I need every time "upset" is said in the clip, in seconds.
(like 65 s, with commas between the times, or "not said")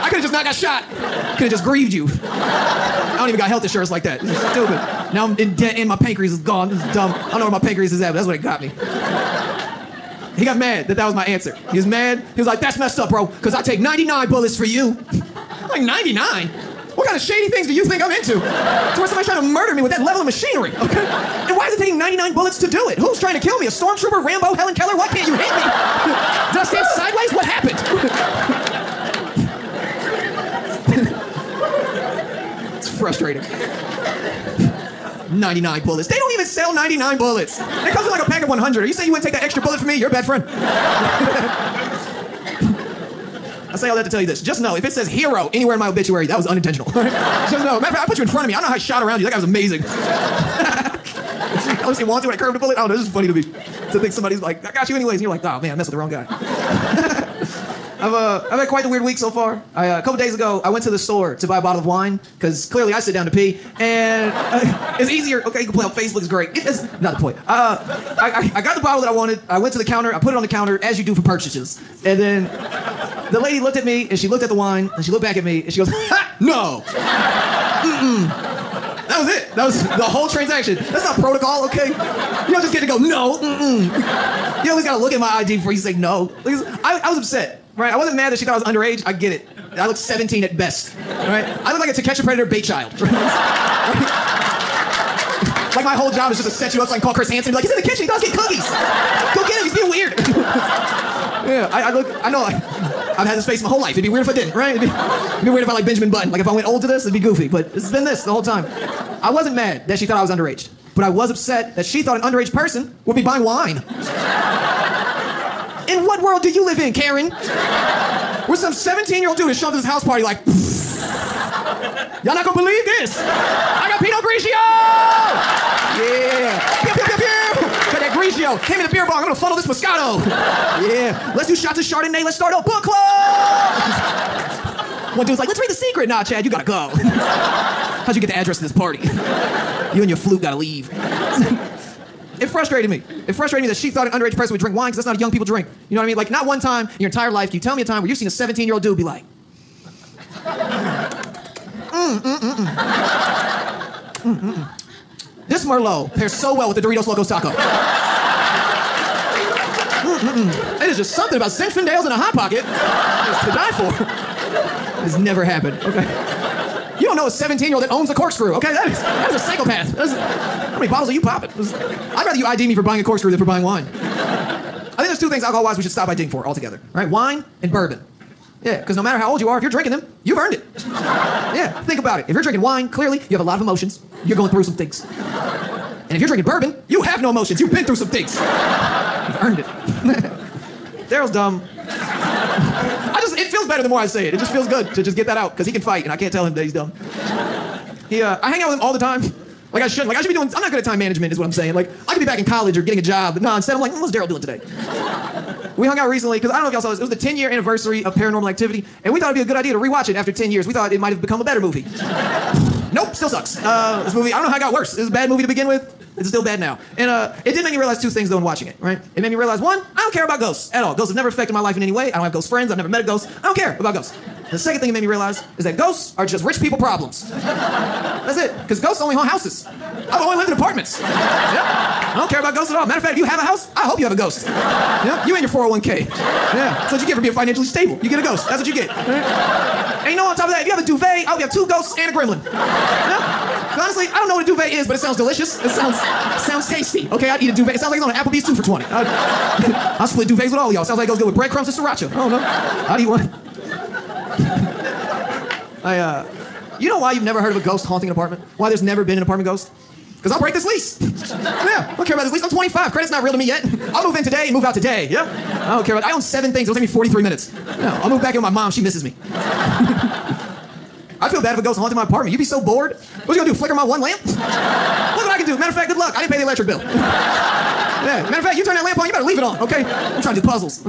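87 s, 111 s.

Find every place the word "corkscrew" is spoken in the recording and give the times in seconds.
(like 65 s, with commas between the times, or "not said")
168 s, 173 s.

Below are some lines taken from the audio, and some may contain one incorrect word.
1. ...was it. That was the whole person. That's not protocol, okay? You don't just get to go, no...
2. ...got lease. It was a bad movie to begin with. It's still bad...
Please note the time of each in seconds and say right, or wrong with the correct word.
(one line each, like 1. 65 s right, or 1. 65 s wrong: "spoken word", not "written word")
1. 79 s wrong: "transaction", not "person"
2. 214 s wrong: "worse", not "lease".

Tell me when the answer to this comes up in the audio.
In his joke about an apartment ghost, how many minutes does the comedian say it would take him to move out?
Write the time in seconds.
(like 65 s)
266 s.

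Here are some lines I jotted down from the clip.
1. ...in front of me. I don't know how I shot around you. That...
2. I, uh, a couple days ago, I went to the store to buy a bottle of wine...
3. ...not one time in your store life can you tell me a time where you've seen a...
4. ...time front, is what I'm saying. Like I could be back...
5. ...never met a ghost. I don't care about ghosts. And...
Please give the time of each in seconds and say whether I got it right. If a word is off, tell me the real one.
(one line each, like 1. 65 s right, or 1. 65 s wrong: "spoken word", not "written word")
1. 48 s right
2. 59 s right
3. 146 s wrong: "entire", not "store"
4. 200 s wrong: "management", not "front"
5. 222 s right.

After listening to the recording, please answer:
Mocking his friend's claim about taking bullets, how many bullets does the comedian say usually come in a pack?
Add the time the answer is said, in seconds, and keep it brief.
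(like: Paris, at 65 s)
100, at 38 s.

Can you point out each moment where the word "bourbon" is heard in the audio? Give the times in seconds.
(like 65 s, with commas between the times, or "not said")
177 s, 186 s.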